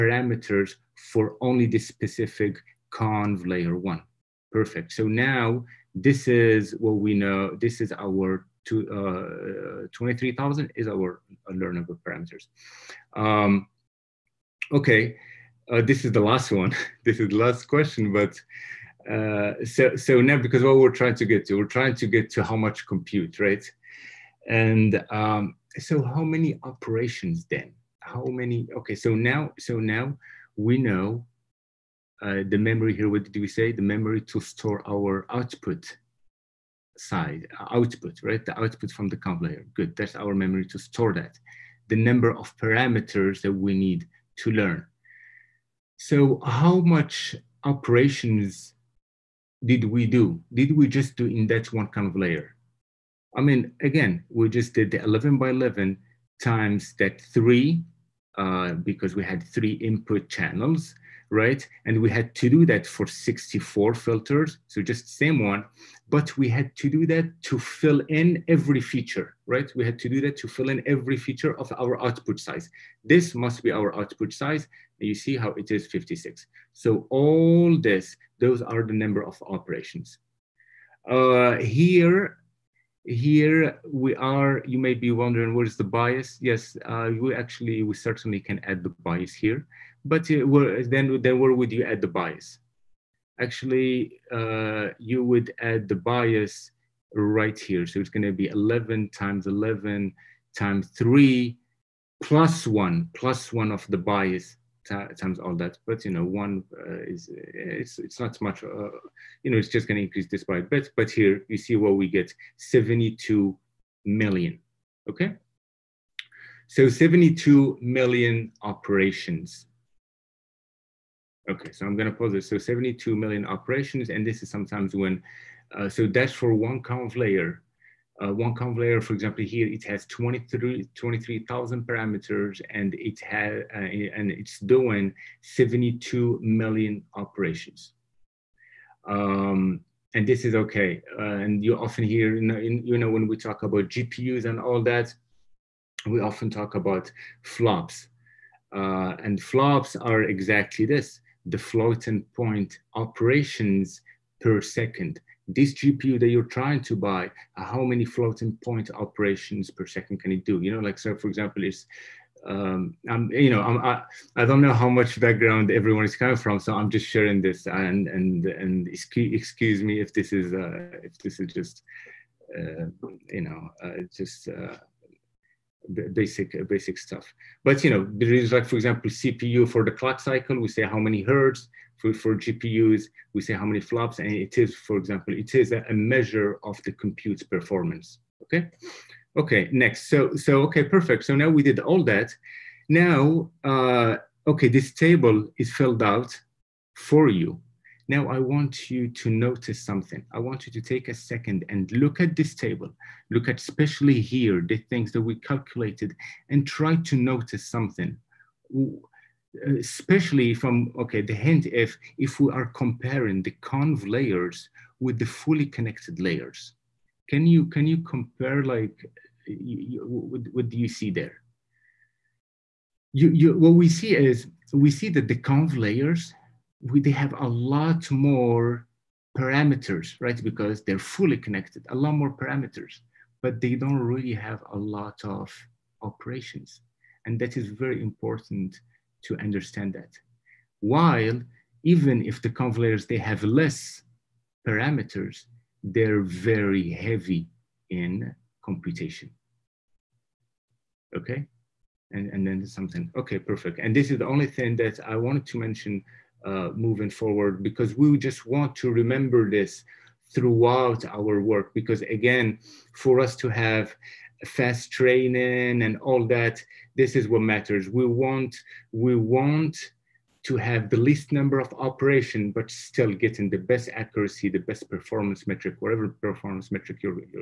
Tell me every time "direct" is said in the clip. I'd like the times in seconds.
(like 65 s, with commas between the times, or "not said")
not said.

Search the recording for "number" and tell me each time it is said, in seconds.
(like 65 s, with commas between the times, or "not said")
41 s, 78 s, 271 s.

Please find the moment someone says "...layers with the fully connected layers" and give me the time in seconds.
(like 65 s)
214 s.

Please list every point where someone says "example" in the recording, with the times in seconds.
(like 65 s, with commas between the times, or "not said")
129 s, 161 s, 178 s, 184 s.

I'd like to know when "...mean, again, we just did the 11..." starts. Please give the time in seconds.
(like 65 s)
53 s.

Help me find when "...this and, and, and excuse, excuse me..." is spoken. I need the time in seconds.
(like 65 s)
167 s.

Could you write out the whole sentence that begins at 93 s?
Actually, uh, you would add the bias right here.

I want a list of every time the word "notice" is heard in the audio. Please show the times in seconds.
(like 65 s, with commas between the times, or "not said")
199 s, 207 s.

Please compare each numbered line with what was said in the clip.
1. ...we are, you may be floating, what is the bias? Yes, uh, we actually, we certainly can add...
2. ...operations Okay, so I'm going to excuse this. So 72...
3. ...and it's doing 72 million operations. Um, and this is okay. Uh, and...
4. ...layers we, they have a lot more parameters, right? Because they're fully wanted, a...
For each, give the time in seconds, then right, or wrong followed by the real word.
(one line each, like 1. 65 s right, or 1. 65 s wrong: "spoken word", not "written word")
1. 83 s wrong: "wondering", not "floating"
2. 118 s wrong: "pause", not "excuse"
3. 133 s right
4. 225 s wrong: "connected", not "wanted".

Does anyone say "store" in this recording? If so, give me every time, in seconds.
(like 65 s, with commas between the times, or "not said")
34 s, 40 s.